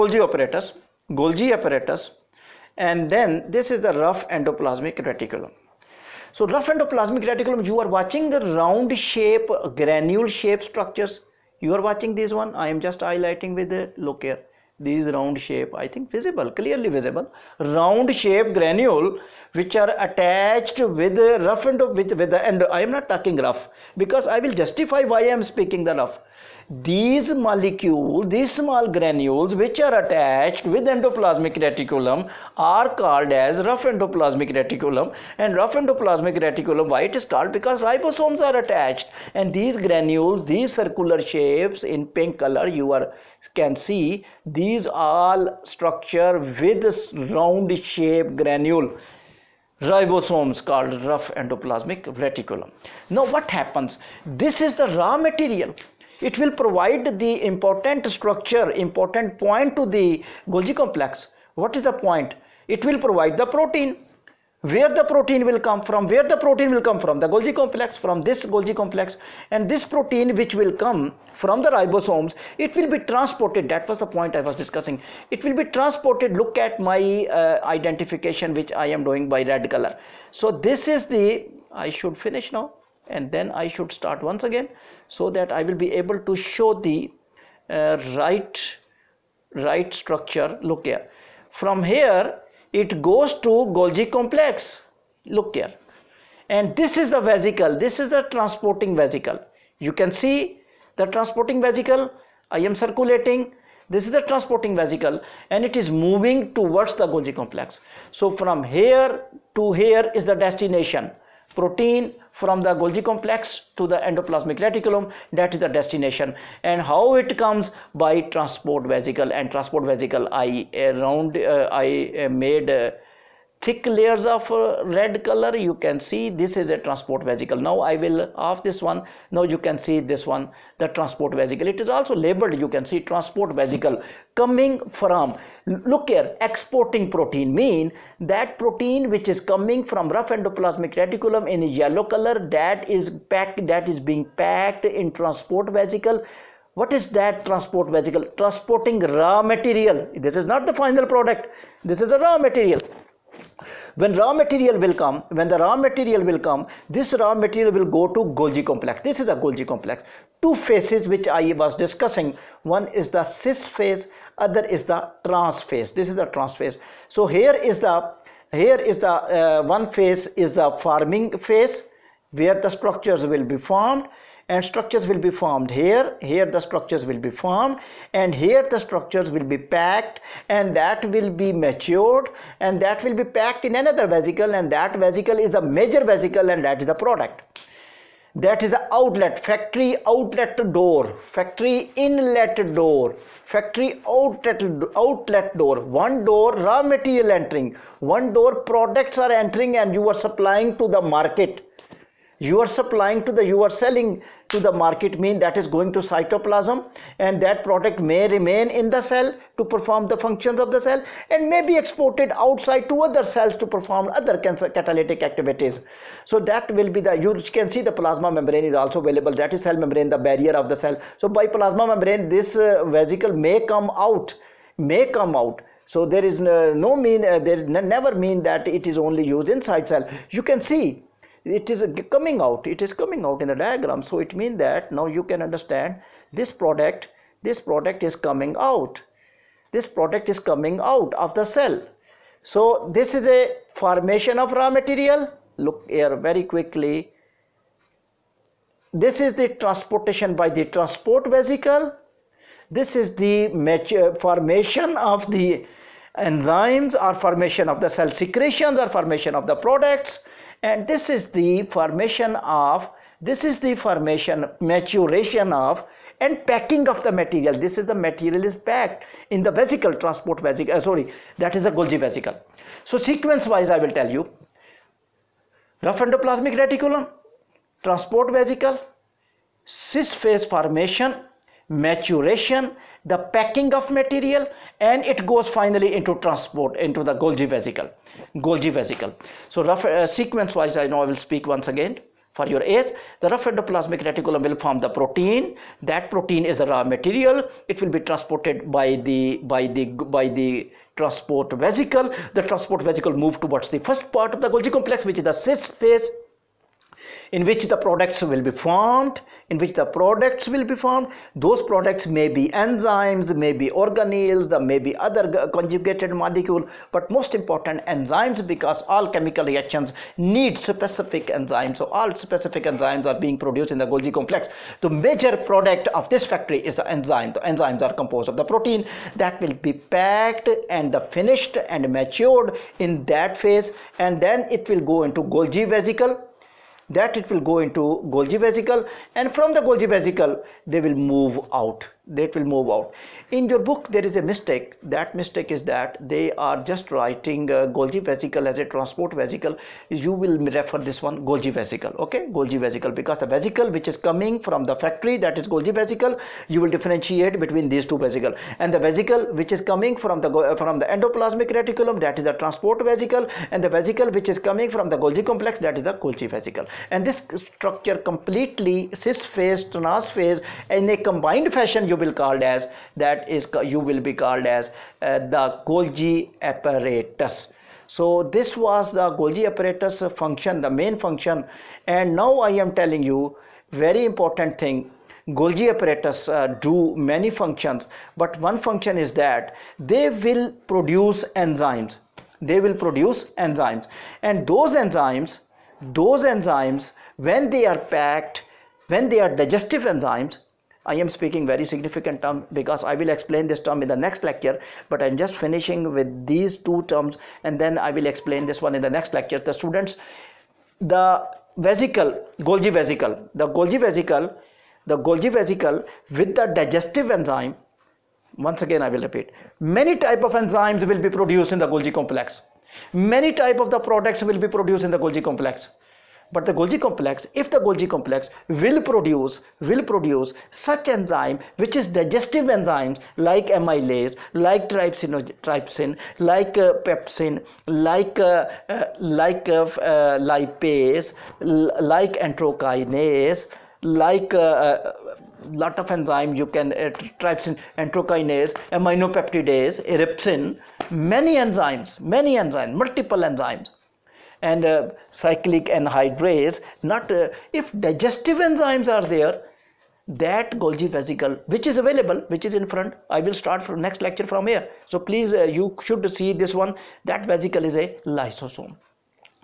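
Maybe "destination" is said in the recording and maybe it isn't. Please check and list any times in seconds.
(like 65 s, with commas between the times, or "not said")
110 s, 115 s.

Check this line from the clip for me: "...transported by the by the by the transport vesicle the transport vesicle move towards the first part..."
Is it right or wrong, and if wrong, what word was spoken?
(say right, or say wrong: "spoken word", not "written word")
right.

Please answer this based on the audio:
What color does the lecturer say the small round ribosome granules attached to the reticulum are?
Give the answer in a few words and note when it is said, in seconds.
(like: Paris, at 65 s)
Pink, at 42 s.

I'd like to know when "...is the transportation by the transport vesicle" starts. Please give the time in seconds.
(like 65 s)
249 s.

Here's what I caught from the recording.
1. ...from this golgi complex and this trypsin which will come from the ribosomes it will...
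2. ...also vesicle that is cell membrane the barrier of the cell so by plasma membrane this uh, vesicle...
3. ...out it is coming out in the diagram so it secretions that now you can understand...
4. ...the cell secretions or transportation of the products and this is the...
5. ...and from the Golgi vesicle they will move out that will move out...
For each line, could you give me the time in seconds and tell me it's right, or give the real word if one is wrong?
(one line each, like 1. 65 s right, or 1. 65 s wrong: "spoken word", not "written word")
1. 68 s wrong: "protein", not "trypsin"
2. 218 s wrong: "available", not "vesicle"
3. 232 s wrong: "means", not "secretions"
4. 257 s wrong: "formation", not "transportation"
5. 339 s right.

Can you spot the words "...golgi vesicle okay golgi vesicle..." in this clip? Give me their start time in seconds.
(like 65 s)
351 s.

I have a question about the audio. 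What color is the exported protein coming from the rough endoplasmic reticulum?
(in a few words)
Yellow.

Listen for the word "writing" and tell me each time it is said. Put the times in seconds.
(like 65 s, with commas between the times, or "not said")
346 s.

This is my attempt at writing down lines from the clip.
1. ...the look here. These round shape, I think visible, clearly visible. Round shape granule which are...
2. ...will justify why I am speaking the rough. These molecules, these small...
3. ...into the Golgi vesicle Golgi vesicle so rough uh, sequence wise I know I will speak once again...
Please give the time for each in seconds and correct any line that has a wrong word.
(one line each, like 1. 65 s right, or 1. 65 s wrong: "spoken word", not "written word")
1. 13 s right
2. 24 s right
3. 286 s right.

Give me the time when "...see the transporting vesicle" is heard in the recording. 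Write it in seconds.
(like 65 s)
100 s.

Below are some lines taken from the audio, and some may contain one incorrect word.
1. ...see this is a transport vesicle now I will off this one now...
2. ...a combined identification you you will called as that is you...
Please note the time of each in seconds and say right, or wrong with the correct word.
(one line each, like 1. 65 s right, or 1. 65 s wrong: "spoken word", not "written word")
1. 126 s right
2. 370 s wrong: "fashion", not "identification".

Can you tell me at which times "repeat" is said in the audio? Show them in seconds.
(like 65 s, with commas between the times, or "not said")
419 s.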